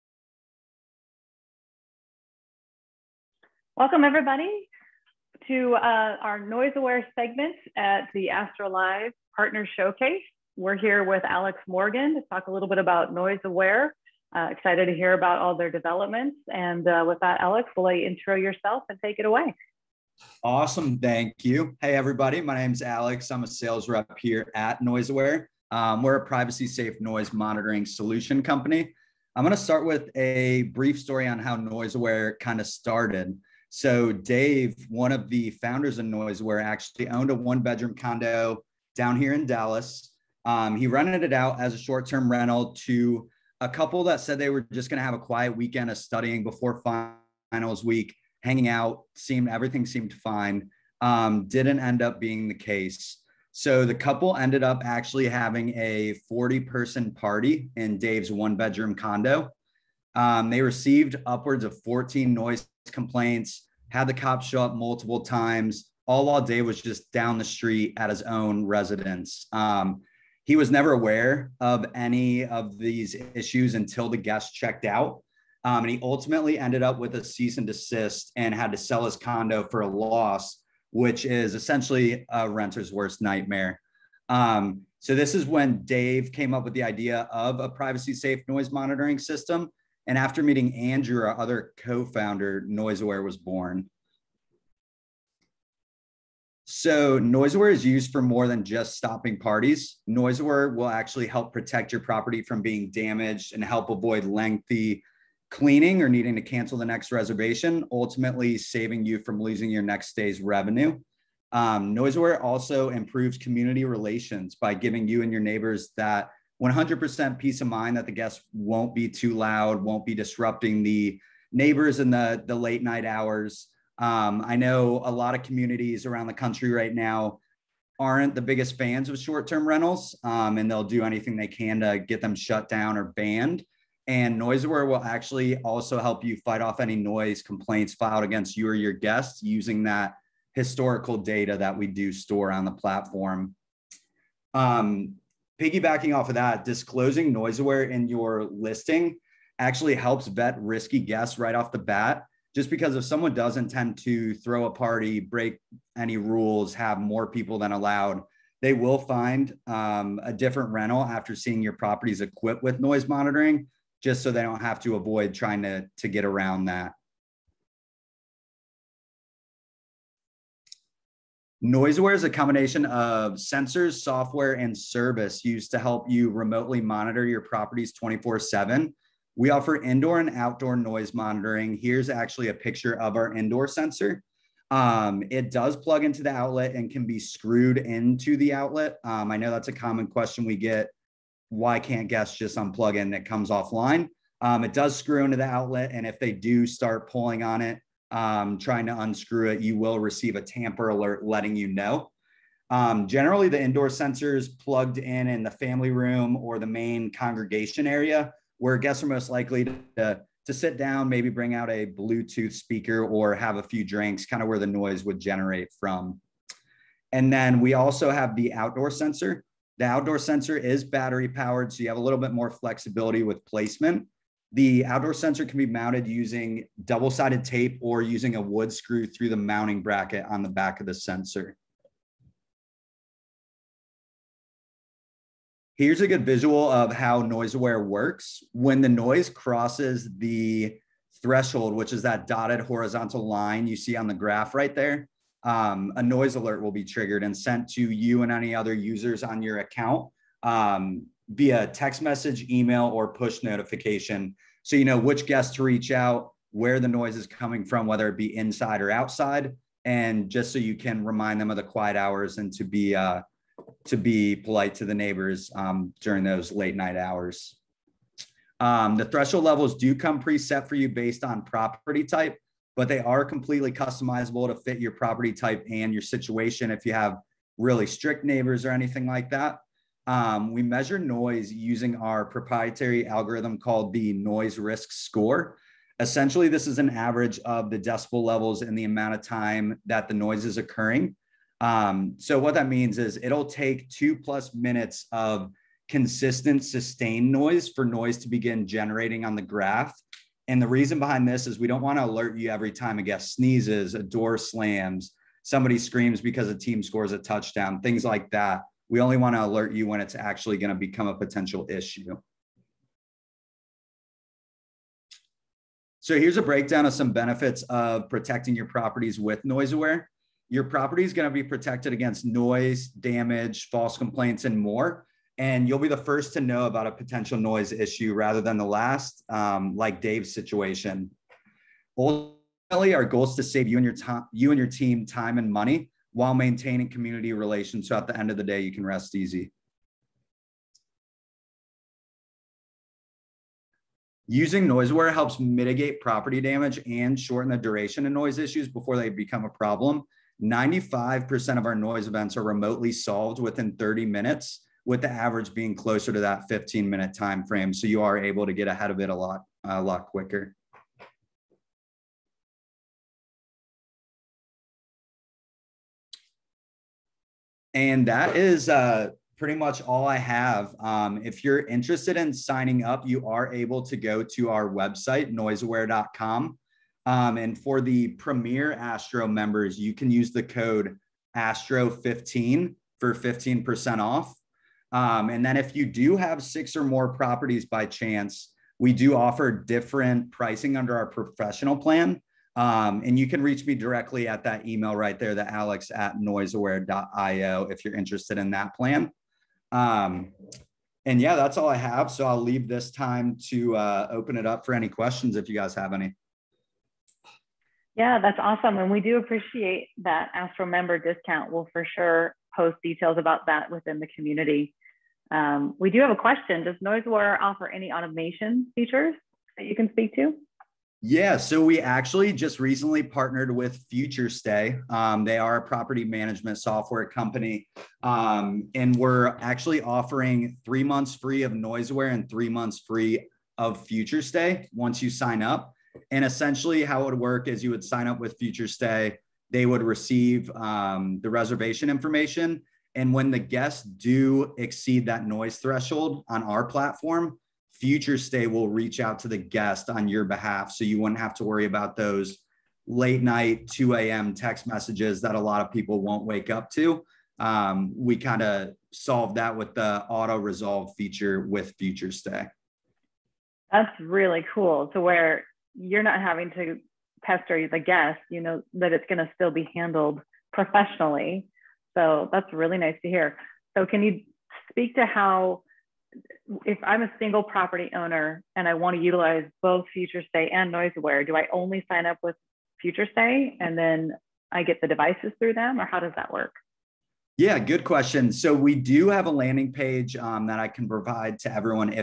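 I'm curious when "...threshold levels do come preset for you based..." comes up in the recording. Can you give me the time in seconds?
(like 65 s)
269 s.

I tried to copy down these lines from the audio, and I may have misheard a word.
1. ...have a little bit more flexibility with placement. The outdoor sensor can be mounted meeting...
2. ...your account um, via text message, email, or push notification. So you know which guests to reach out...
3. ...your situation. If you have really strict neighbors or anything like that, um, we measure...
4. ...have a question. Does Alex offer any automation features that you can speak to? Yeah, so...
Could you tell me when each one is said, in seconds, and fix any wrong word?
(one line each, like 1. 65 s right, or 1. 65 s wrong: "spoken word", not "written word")
1. 221 s wrong: "using", not "meeting"
2. 249 s right
3. 275 s right
4. 416 s wrong: "NoiseAware", not "Alex".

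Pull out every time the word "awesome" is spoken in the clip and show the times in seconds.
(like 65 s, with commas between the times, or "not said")
20 s, 408 s.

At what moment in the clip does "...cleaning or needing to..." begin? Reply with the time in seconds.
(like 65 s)
105 s.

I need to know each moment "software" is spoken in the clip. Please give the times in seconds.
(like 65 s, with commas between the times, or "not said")
174 s, 426 s.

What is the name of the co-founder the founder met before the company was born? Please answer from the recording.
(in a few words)
Andrew.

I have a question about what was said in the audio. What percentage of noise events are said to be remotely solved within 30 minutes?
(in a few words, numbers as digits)
95%.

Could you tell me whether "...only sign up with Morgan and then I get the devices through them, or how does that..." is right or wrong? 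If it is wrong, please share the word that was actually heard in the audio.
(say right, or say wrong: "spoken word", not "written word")
wrong: "FutureStay", not "Morgan".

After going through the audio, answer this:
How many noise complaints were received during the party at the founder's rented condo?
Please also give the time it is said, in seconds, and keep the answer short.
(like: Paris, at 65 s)
14, at 61 s.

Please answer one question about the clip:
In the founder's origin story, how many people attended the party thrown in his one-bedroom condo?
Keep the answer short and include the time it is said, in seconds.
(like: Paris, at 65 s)
40, at 56 s.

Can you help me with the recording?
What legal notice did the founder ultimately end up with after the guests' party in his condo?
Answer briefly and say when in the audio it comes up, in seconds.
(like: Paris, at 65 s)
Cease and desist, at 77 s.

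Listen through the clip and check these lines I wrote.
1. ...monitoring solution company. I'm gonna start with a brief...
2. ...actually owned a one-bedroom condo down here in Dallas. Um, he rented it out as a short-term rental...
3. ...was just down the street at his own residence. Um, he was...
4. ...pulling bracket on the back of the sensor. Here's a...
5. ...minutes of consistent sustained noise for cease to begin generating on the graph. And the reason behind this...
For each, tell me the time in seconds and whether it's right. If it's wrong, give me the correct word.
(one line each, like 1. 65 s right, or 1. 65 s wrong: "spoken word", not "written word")
1. 27 s right
2. 36 s right
3. 66 s right
4. 229 s wrong: "mounting", not "pulling"
5. 294 s wrong: "noise", not "cease".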